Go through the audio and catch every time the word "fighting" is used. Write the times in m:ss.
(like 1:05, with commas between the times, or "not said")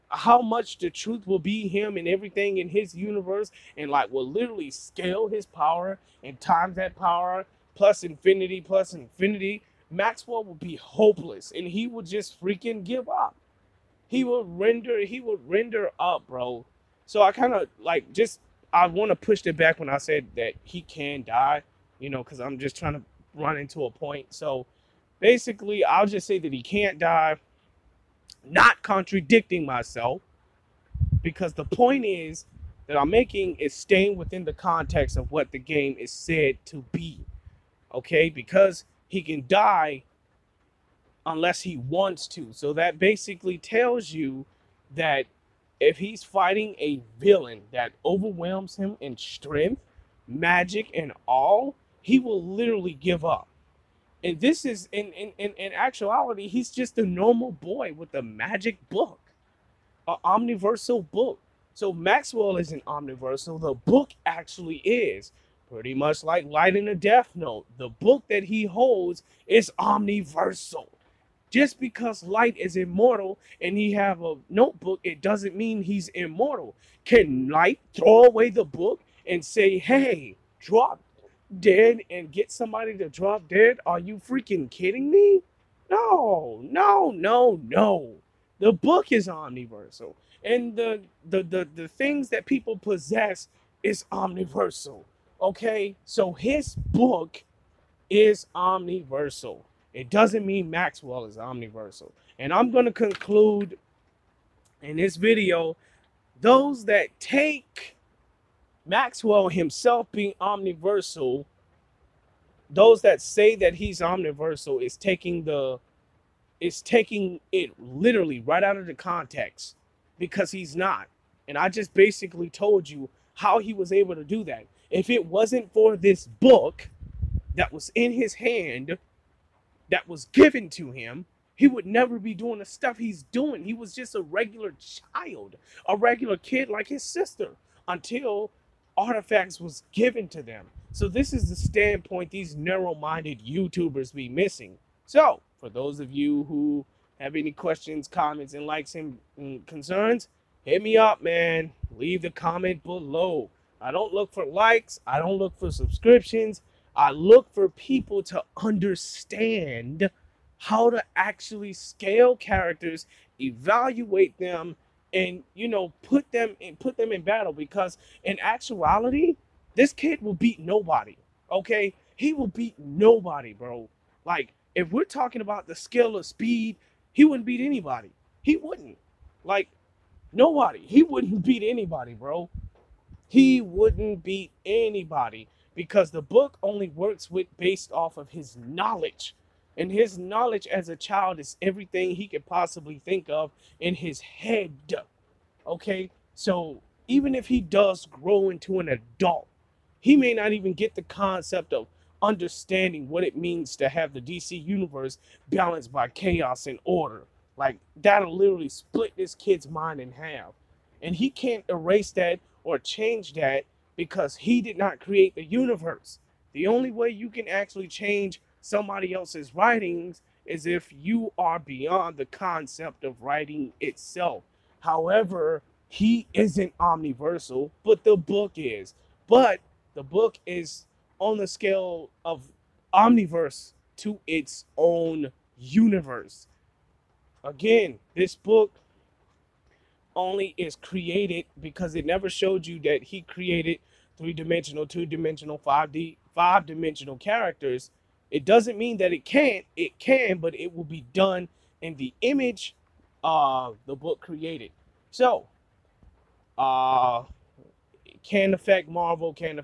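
0:46.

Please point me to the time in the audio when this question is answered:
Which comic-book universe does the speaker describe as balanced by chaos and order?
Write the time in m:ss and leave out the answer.
3:24.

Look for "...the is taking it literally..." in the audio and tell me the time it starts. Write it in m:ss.
1:55.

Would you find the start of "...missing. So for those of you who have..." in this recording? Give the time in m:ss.
2:24.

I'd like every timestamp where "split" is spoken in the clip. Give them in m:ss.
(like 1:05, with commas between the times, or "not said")
3:28.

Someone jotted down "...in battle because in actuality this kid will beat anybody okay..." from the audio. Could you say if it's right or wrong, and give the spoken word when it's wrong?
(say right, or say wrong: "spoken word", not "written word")
wrong: "nobody", not "anybody".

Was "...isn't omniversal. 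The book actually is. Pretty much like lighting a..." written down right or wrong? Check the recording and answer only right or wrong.
right.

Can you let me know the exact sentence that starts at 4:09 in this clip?
It can, but it will be done in the image of the book created.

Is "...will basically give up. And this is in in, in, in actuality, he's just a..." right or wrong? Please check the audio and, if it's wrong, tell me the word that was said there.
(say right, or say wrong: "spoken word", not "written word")
wrong: "literally", not "basically".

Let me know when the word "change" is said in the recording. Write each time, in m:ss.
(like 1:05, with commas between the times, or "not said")
3:32, 3:37.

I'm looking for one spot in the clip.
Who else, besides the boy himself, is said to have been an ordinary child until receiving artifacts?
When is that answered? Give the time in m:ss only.
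2:16.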